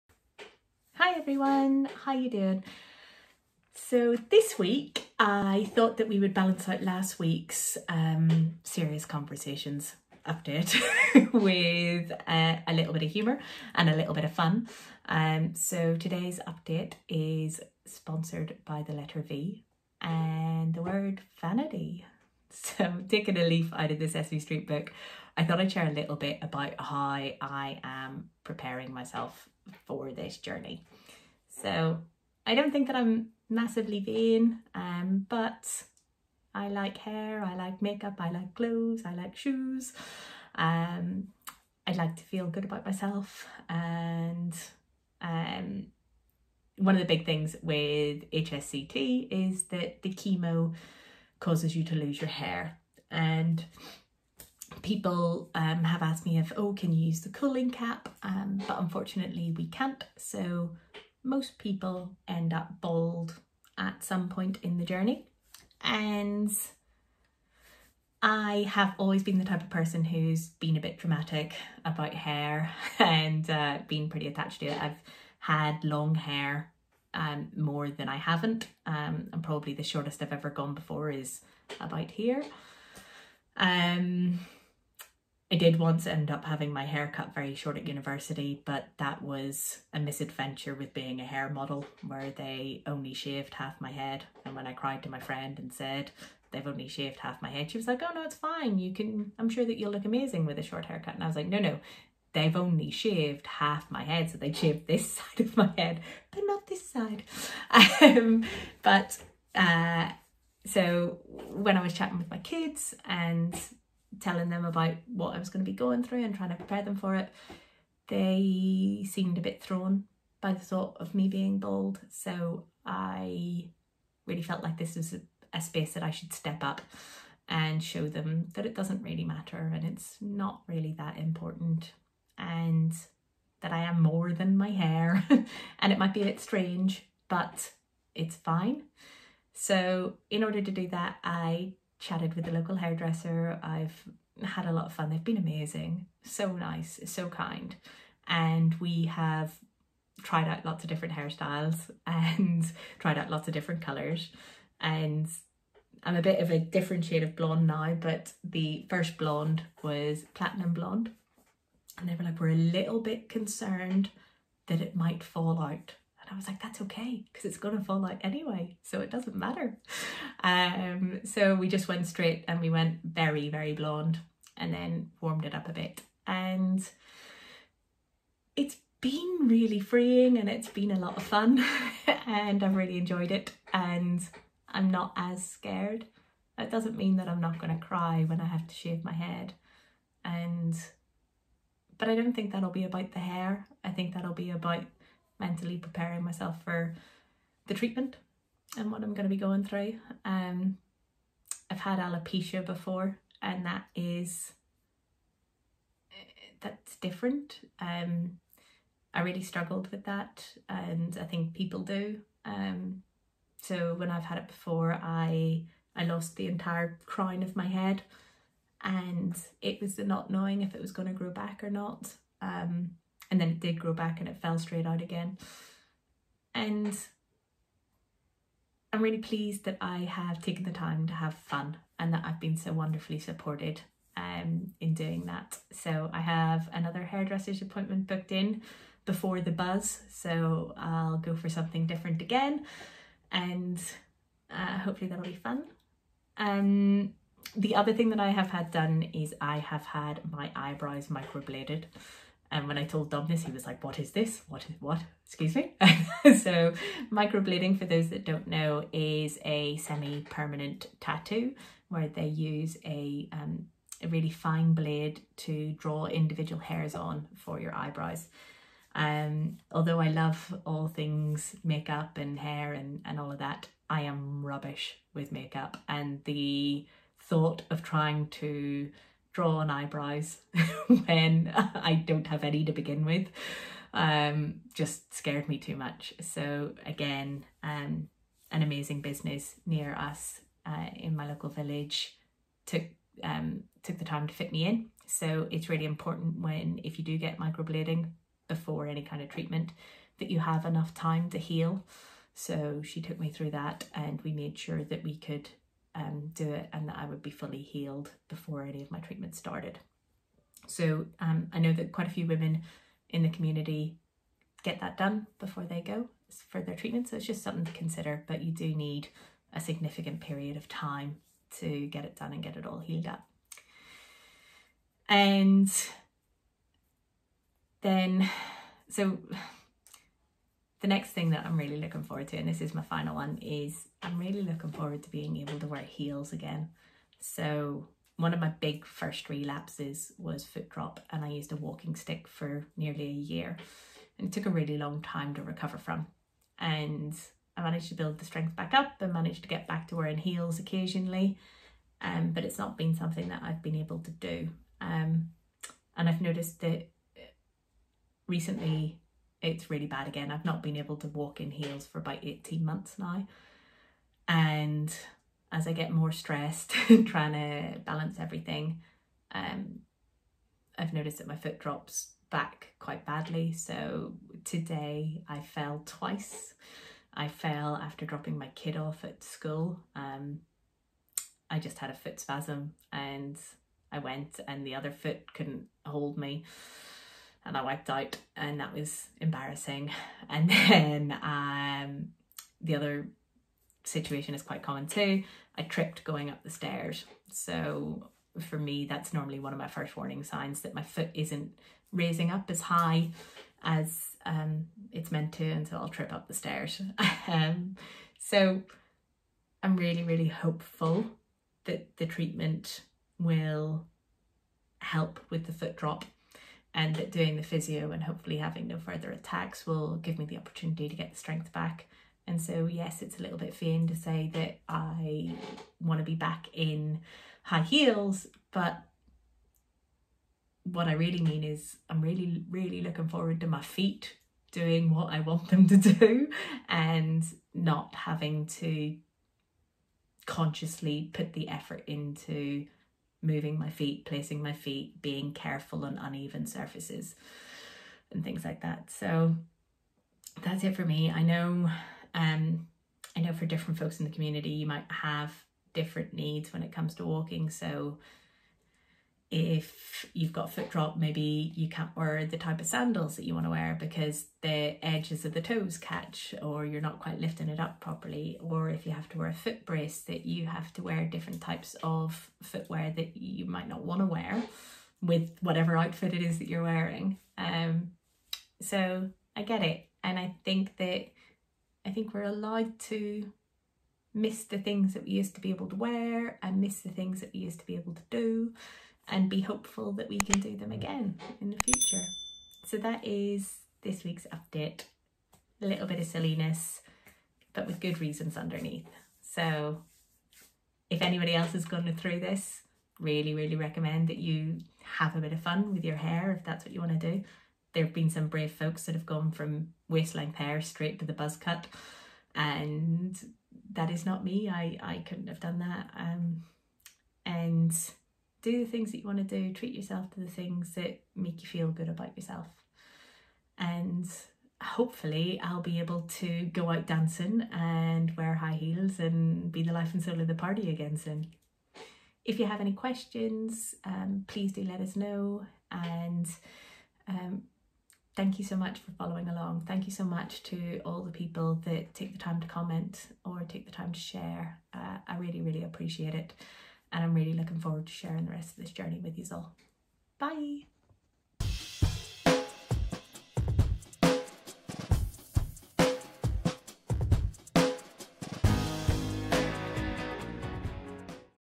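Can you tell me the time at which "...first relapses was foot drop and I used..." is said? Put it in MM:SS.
05:38.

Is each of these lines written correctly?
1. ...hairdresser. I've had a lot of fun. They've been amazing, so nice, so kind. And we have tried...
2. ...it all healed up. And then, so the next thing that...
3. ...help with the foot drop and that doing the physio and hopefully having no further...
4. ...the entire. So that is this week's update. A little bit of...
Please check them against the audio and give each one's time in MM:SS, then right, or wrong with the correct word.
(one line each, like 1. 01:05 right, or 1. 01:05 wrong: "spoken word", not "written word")
1. 02:22 right
2. 05:22 right
3. 06:54 right
4. 08:11 wrong: "future", not "entire".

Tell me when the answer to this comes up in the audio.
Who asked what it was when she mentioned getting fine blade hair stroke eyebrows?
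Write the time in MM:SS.
04:13.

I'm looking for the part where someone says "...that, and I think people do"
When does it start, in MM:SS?
03:30.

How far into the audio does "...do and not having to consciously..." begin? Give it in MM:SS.
07:15.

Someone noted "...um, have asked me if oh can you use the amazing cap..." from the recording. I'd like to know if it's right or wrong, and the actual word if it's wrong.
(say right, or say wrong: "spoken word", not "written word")
wrong: "cooling", not "amazing".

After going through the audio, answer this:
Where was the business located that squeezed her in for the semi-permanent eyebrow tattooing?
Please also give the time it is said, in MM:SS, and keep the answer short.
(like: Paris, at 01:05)
local village, at 04:51.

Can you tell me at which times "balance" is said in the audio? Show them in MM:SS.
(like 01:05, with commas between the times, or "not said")
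00:06, 06:07.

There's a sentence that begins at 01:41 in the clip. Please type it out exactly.
And I was like, no, no, they've only shaved half my head.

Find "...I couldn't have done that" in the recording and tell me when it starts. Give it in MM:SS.
08:34.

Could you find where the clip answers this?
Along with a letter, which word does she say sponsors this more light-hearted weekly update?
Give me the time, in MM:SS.
00:21.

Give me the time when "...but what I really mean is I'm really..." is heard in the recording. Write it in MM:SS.
07:08.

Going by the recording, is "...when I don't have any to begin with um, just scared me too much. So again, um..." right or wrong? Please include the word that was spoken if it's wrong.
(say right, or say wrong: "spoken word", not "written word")
right.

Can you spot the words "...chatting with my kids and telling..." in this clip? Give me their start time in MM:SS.
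01:51.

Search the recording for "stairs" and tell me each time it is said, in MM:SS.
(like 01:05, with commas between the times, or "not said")
06:36, 06:46.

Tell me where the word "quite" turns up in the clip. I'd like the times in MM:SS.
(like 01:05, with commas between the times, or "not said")
05:11, 06:12, 06:34, 07:46.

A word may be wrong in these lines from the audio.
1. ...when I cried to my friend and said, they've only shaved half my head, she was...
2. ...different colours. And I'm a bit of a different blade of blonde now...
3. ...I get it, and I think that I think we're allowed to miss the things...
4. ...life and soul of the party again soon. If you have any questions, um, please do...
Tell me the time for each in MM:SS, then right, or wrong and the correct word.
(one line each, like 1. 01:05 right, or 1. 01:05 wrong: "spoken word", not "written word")
1. 01:34 right
2. 02:33 wrong: "shade", not "blade"
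3. 07:59 right
4. 08:49 right.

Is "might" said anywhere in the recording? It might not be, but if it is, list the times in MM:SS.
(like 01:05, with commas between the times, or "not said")
02:15, 02:44, 07:34, 07:53.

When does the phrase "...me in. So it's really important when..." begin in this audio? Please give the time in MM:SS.
04:54.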